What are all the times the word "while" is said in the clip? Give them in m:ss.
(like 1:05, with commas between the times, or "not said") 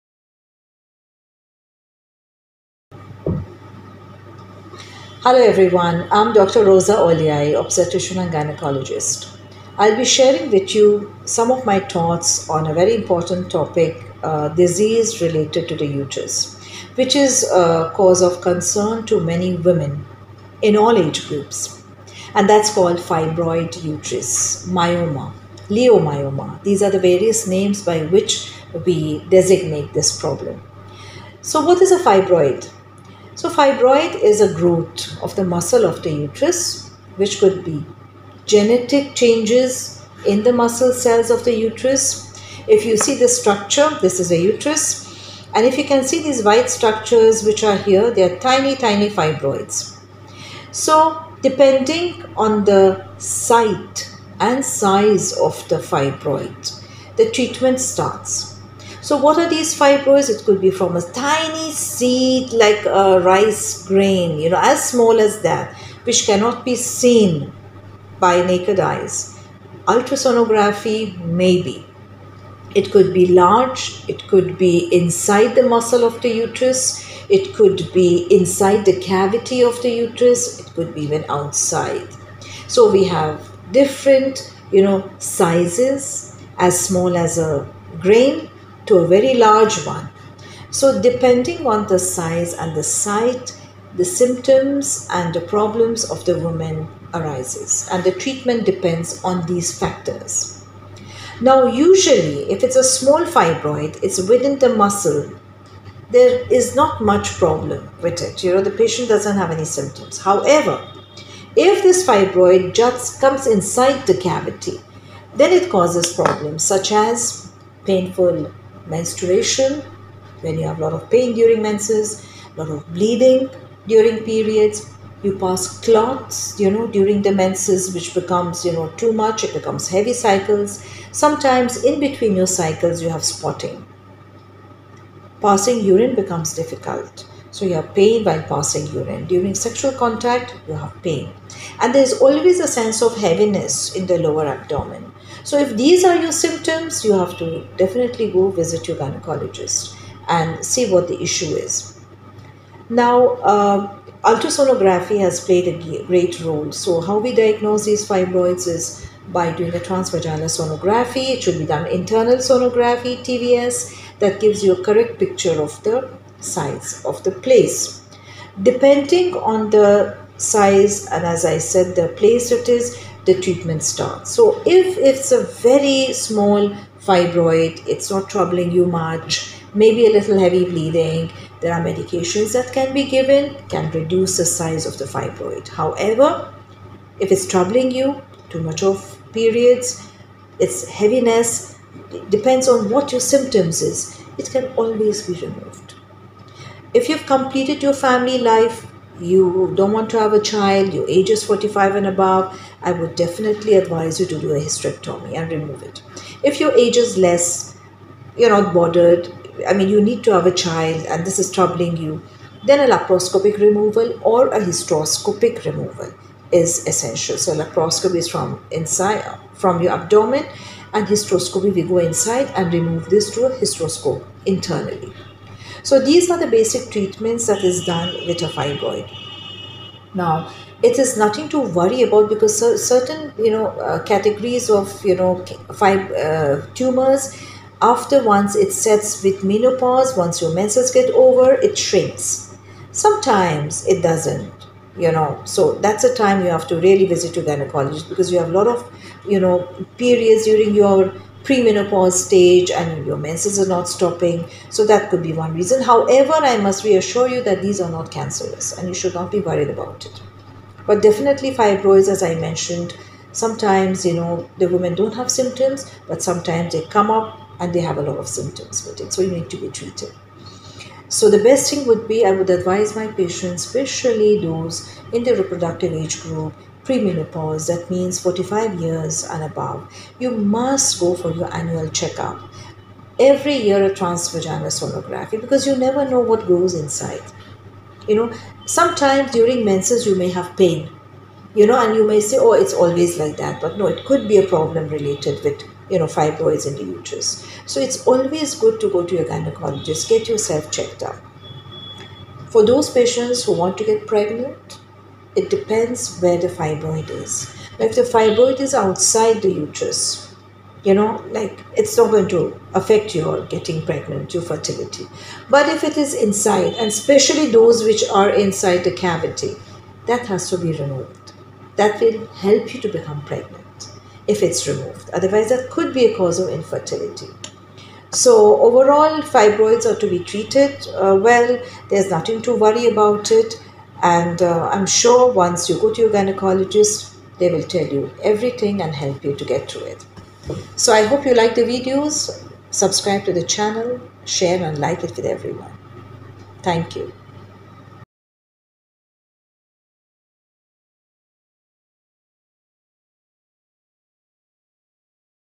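2:18.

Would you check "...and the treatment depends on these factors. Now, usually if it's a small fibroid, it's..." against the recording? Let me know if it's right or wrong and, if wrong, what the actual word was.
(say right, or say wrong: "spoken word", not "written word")
right.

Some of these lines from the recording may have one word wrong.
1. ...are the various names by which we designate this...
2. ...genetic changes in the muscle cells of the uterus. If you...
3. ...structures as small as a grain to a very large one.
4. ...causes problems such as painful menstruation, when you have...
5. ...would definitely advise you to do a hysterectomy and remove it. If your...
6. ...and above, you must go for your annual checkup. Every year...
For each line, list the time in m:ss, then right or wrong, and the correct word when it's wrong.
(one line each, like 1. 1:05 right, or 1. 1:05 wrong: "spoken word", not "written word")
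1. 0:26 right
2. 0:38 right
3. 1:25 wrong: "sizes", not "structures"
4. 1:55 right
5. 3:22 right
6. 4:39 right.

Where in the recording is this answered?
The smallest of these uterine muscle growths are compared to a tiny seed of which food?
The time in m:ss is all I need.
1:03.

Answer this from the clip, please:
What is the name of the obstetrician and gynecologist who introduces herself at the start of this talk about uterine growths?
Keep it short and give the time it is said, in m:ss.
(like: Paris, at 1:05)
Roza Olyai, at 0:06.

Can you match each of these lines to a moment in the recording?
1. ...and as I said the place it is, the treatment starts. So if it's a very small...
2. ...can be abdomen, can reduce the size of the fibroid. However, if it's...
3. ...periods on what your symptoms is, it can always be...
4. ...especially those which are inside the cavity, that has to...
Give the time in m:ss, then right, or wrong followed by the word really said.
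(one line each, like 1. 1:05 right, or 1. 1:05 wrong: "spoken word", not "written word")
1. 2:51 right
2. 3:02 wrong: "given", not "abdomen"
3. 3:12 wrong: "depends", not "periods"
4. 5:16 right.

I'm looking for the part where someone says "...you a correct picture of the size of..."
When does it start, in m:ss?
2:44.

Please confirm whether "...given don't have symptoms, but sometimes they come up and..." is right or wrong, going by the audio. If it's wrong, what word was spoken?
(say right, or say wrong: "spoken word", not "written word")
wrong: "women", not "given".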